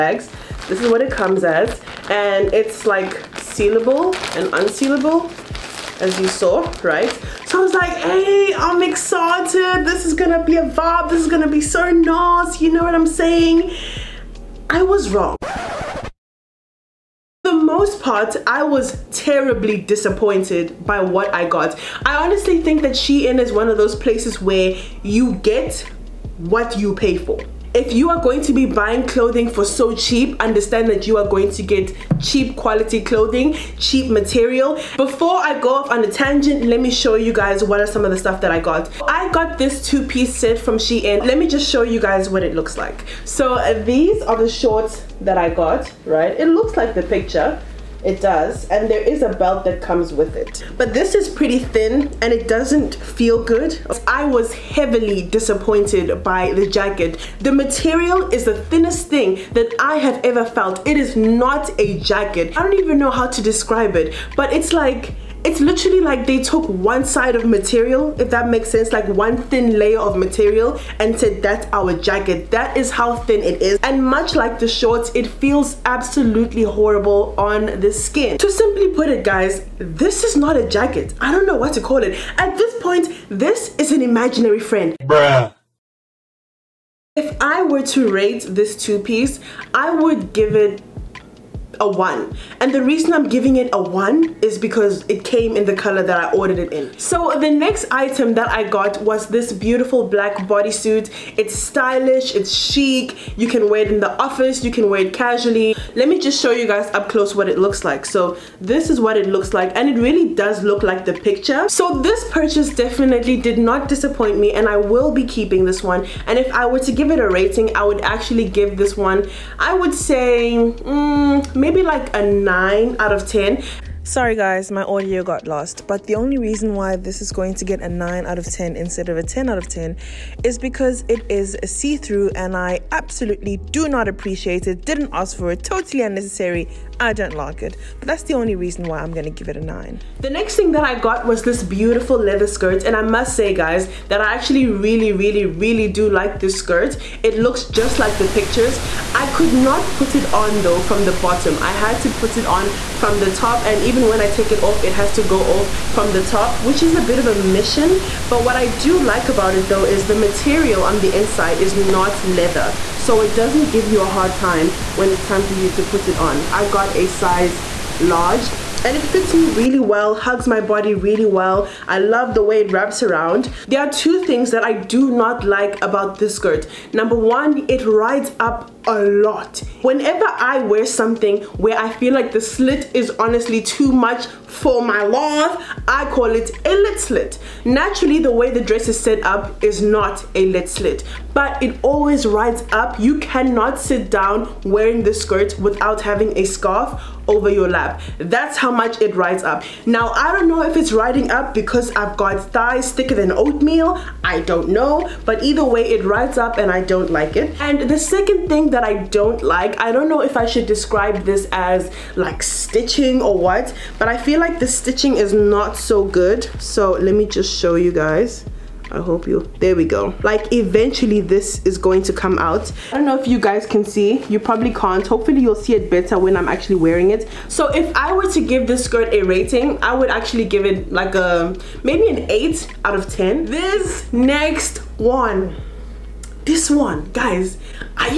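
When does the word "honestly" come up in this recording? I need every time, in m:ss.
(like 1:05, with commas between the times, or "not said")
0:22, 3:03.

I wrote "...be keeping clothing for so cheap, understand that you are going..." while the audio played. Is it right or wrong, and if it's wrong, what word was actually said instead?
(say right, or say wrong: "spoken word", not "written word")
wrong: "buying", not "keeping".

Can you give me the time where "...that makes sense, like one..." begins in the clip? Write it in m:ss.
1:08.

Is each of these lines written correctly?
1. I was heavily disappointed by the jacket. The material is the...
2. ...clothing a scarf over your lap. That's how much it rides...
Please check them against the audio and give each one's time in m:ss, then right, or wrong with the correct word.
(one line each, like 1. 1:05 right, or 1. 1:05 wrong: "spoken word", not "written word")
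1. 0:54 right
2. 3:16 wrong: "having", not "clothing".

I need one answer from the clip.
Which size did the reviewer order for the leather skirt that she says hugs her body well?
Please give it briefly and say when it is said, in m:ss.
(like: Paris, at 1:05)
Large, at 2:47.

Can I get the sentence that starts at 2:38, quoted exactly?
But what I do like about it though is the material on the inside is not leather.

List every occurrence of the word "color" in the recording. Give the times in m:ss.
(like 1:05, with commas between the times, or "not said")
1:35.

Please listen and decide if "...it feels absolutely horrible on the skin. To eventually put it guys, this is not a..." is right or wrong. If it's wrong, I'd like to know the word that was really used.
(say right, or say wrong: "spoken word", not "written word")
wrong: "simply", not "eventually".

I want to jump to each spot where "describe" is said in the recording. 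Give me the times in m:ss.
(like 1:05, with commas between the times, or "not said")
1:03, 3:30.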